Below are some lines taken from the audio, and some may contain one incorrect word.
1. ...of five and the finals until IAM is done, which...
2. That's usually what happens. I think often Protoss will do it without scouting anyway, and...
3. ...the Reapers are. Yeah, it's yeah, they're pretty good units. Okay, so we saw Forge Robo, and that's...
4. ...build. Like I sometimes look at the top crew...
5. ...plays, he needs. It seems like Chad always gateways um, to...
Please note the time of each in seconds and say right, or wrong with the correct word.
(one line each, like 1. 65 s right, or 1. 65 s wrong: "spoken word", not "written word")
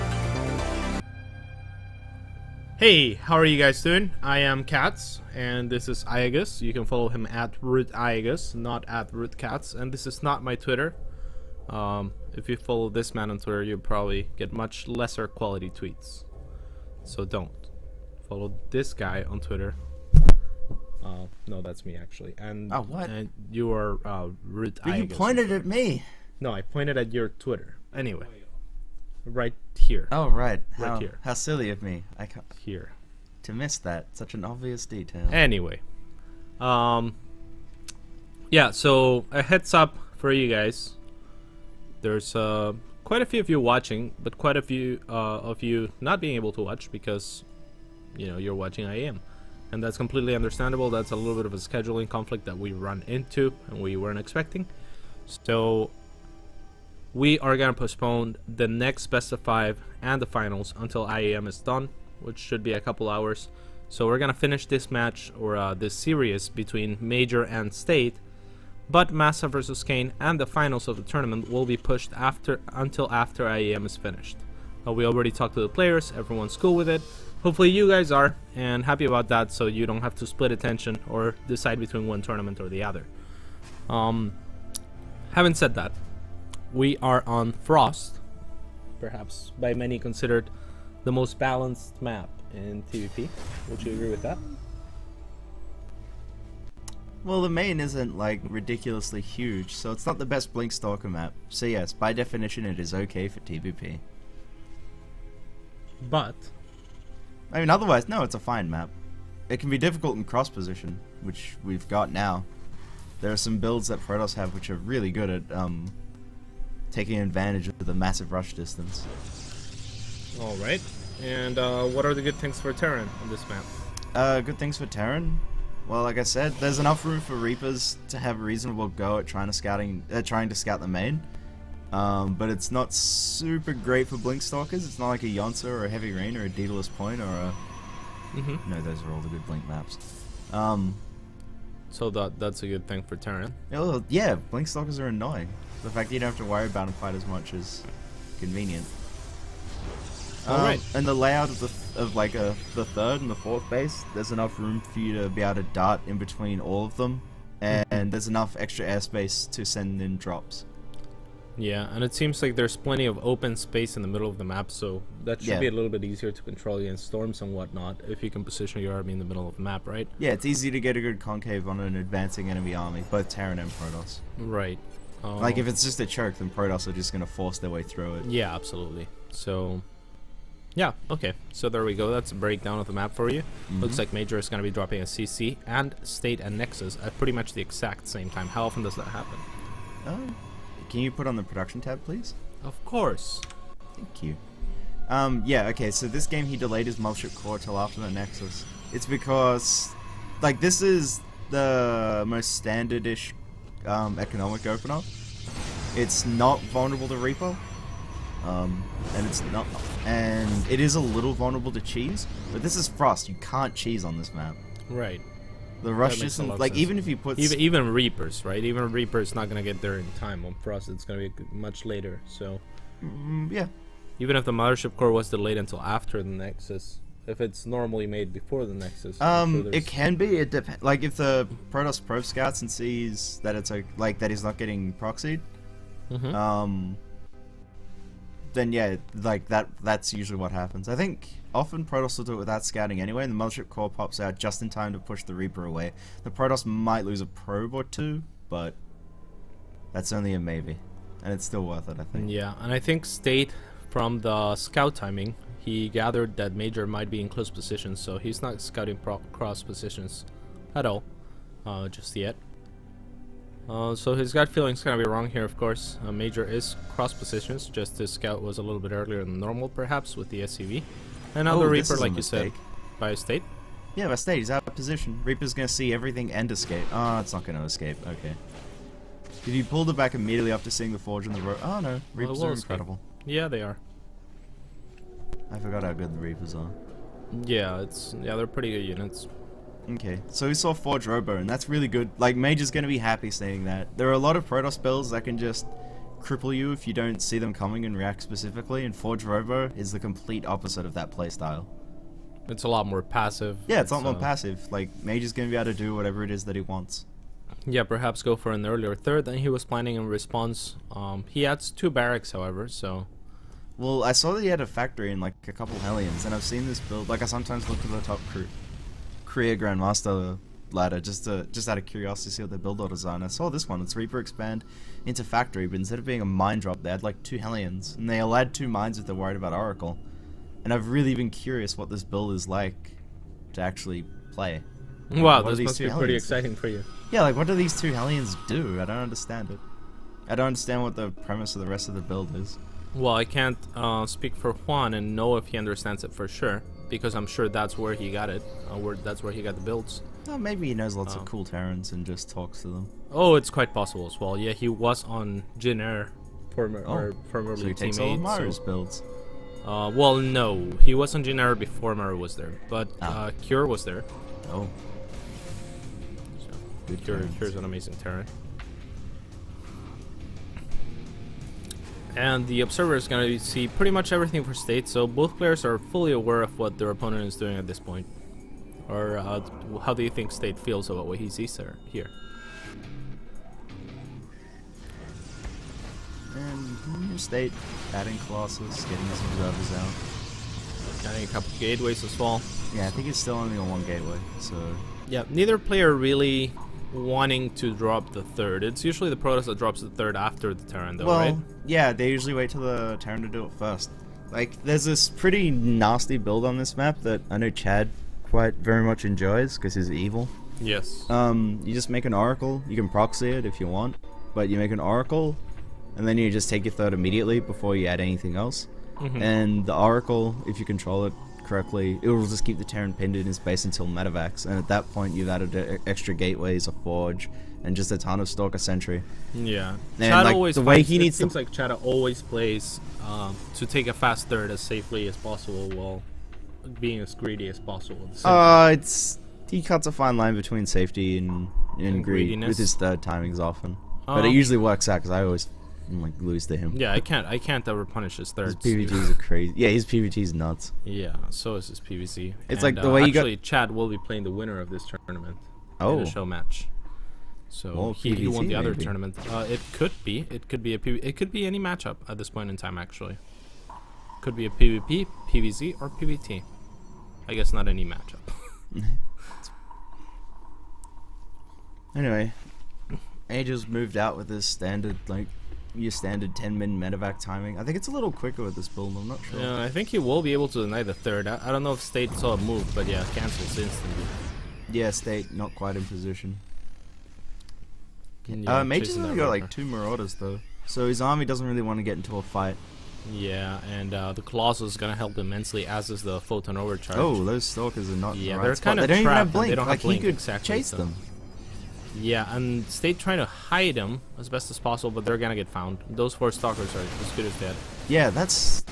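1. 59 s right
2. 239 s right
3. 286 s right
4. 316 s right
5. 430 s wrong: "plays", not "gateways".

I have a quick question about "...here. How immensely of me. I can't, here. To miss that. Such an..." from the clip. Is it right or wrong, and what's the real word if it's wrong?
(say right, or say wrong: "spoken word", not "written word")
wrong: "silly", not "immensely".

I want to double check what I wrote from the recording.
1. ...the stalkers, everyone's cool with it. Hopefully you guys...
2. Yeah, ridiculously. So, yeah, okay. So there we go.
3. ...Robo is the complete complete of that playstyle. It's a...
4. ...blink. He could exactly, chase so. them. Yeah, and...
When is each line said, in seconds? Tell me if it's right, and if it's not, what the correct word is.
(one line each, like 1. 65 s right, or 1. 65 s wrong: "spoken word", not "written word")
1. 75 s wrong: "players", not "stalkers"
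2. 178 s wrong: "absolutely", not "ridiculously"
3. 299 s wrong: "opposite", not "complete"
4. 499 s right.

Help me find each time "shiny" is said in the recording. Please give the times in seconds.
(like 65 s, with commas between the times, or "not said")
not said.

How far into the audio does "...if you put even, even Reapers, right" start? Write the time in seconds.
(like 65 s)
216 s.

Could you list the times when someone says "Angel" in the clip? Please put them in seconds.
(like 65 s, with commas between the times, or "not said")
473 s.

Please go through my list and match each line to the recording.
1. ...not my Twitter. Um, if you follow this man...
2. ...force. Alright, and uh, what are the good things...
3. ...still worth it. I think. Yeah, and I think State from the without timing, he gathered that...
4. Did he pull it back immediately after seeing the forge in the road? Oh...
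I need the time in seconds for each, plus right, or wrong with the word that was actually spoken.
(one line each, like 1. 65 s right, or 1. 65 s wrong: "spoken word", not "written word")
1. 10 s right
2. 118 s wrong: "distance", not "force"
3. 251 s wrong: "scout", not "without"
4. 279 s right.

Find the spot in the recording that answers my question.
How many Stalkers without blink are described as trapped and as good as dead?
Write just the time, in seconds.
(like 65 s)
506 s.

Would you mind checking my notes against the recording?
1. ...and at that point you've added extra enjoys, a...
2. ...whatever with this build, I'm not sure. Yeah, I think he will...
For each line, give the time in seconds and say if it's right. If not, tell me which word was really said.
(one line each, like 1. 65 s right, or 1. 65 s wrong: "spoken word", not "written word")
1. 424 s wrong: "gateways", not "enjoys"
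2. 478 s wrong: "quicker", not "whatever".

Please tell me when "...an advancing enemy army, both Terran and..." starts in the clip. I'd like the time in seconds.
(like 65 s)
171 s.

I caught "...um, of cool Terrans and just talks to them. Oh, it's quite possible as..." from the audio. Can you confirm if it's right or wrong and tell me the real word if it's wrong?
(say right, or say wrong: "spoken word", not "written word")
right.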